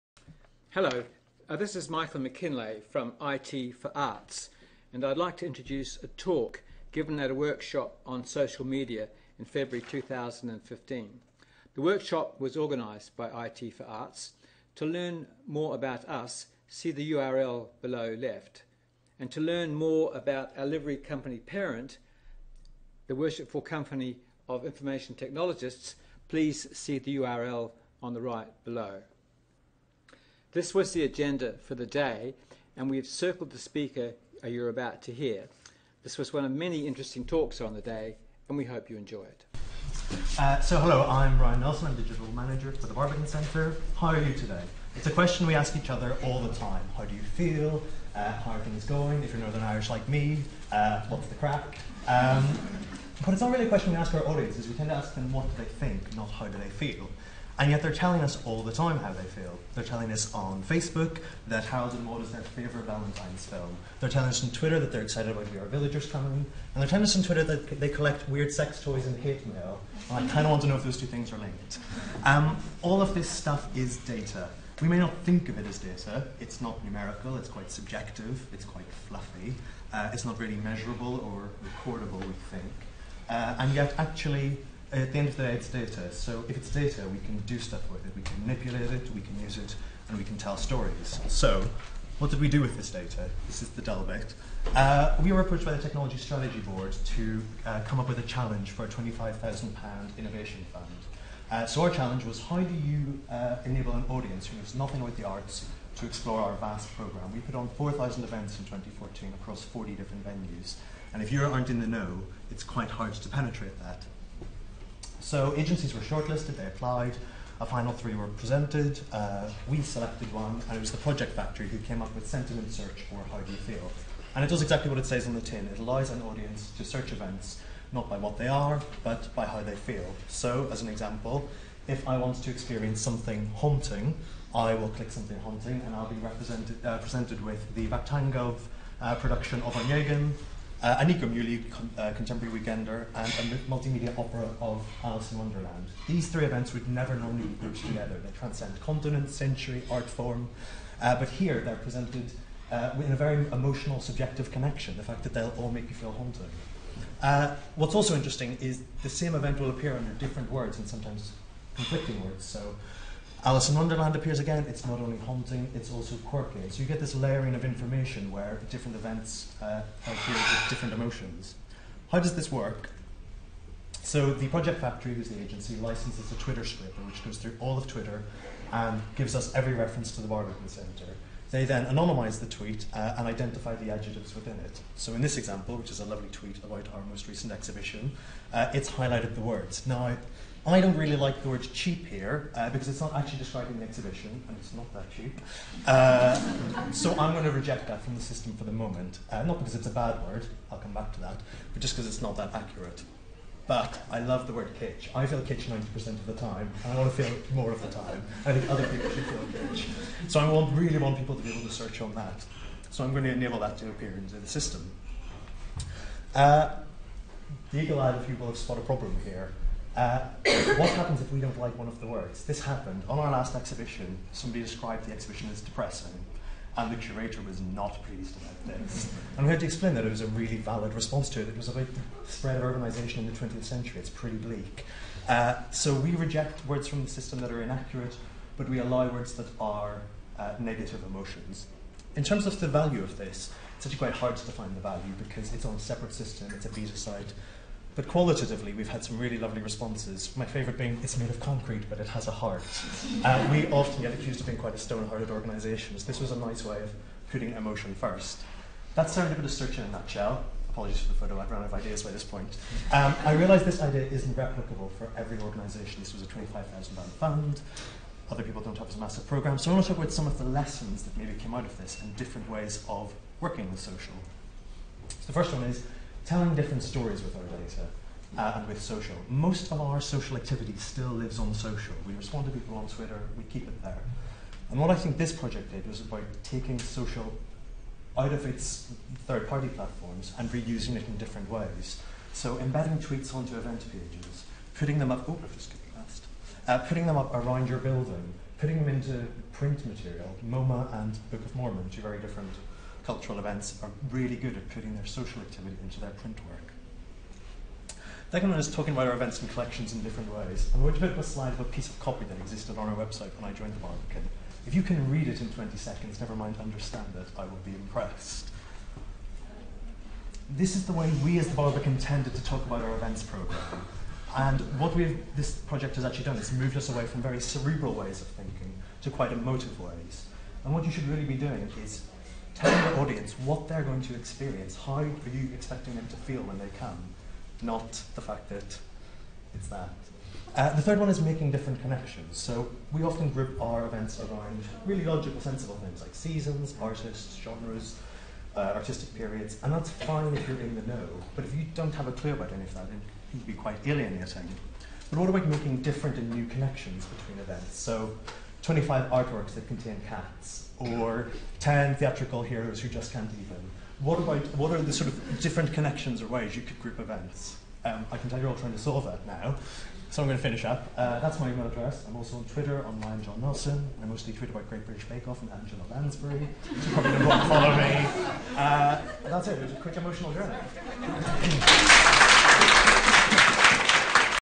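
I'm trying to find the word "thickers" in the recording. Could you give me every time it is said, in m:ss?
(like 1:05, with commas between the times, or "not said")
not said.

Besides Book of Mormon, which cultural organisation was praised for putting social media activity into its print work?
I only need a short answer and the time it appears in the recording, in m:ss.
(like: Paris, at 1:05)
MoMA, at 5:00.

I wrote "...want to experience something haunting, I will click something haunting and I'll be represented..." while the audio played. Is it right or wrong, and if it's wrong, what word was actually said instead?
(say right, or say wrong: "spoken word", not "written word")
right.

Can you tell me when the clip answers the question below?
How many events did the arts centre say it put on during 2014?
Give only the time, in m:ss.
1:47.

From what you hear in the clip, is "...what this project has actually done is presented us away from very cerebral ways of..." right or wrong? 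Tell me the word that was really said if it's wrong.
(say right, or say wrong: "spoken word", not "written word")
wrong: "moved", not "presented".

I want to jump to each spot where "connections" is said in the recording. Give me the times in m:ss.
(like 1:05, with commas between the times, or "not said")
2:34, 5:41, 5:56, 6:05.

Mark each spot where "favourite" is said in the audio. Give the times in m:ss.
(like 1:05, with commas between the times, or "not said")
1:02, 4:10.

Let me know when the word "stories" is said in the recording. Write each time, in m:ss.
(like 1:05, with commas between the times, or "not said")
1:30, 4:36.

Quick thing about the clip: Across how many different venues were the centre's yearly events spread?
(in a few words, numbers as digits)
40.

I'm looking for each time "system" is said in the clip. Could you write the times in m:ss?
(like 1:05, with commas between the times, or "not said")
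3:18, 3:34, 3:57, 4:06.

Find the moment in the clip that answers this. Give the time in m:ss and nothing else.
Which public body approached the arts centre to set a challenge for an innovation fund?
1:35.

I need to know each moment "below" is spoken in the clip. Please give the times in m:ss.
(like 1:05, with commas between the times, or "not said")
0:17, 0:28.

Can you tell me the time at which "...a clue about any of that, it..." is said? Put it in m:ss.
5:52.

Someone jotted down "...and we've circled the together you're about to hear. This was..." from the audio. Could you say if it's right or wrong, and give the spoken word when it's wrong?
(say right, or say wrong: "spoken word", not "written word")
wrong: "speaker", not "together".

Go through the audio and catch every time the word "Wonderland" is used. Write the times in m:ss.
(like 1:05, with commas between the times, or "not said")
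2:25, 2:43.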